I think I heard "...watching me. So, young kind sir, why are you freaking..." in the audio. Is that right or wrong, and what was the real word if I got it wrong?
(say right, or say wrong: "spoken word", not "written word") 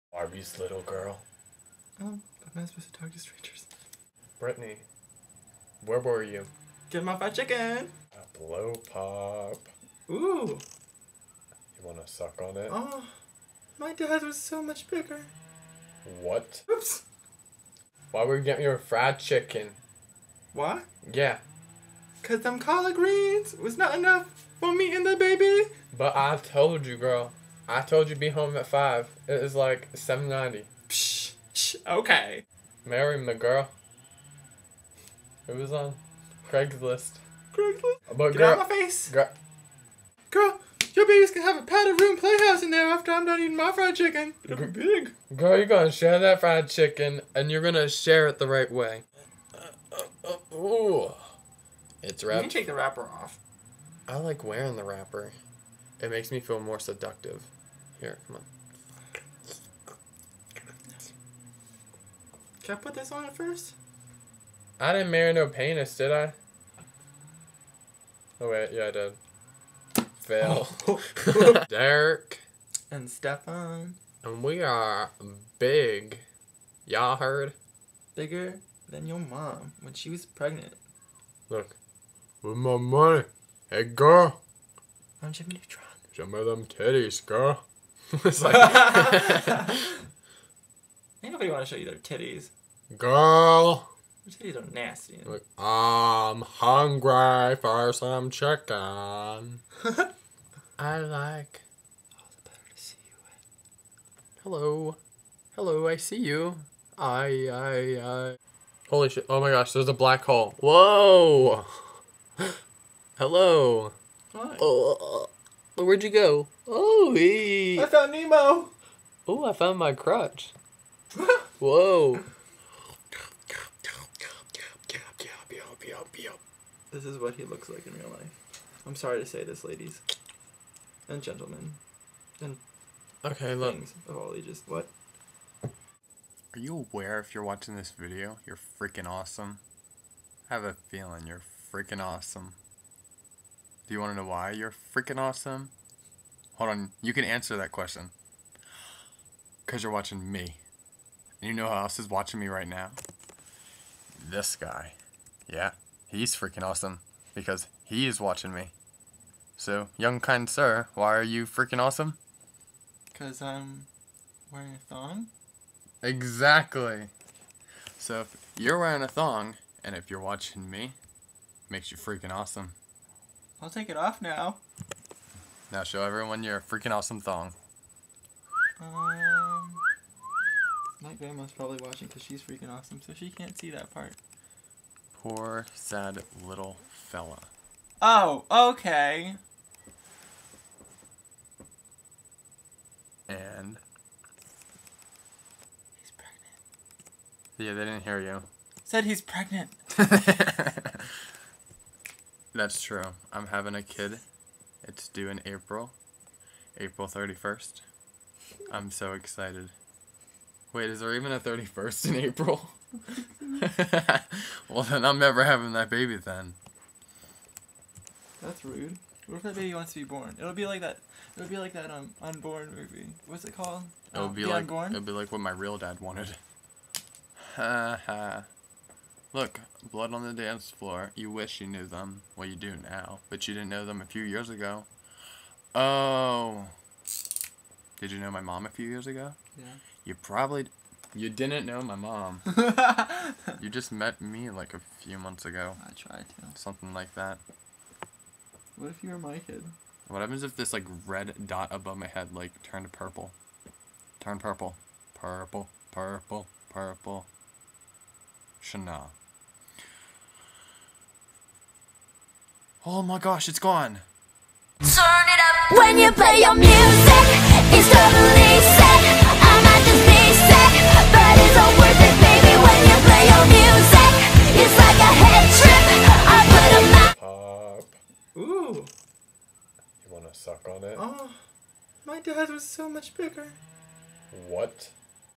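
right.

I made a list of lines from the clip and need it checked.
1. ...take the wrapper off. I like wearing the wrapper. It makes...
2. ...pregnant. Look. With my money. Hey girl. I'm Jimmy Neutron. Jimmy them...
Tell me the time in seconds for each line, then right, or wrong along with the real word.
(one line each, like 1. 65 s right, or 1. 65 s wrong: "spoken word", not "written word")
1. 52 s right
2. 80 s right.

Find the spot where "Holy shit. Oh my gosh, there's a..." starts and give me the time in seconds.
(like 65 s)
108 s.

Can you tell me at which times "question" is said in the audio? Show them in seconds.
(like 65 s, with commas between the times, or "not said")
147 s.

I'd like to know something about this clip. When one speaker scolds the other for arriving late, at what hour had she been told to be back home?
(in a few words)
5.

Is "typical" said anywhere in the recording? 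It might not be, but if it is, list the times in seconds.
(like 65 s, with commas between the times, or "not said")
not said.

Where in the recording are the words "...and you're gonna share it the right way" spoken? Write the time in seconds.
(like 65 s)
47 s.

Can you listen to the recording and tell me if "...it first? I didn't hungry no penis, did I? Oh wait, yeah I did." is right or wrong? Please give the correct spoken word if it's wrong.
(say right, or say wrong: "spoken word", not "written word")
wrong: "marry", not "hungry".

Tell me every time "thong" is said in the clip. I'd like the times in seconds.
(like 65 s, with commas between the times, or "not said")
164 s, 169 s, 177 s.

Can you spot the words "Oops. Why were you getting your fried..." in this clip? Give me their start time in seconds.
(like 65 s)
16 s.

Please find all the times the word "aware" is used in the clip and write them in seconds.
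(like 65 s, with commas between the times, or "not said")
136 s.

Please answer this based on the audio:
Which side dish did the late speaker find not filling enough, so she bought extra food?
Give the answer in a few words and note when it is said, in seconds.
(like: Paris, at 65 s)
collard greens, at 22 s.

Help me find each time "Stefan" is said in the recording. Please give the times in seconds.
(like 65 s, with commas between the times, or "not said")
73 s.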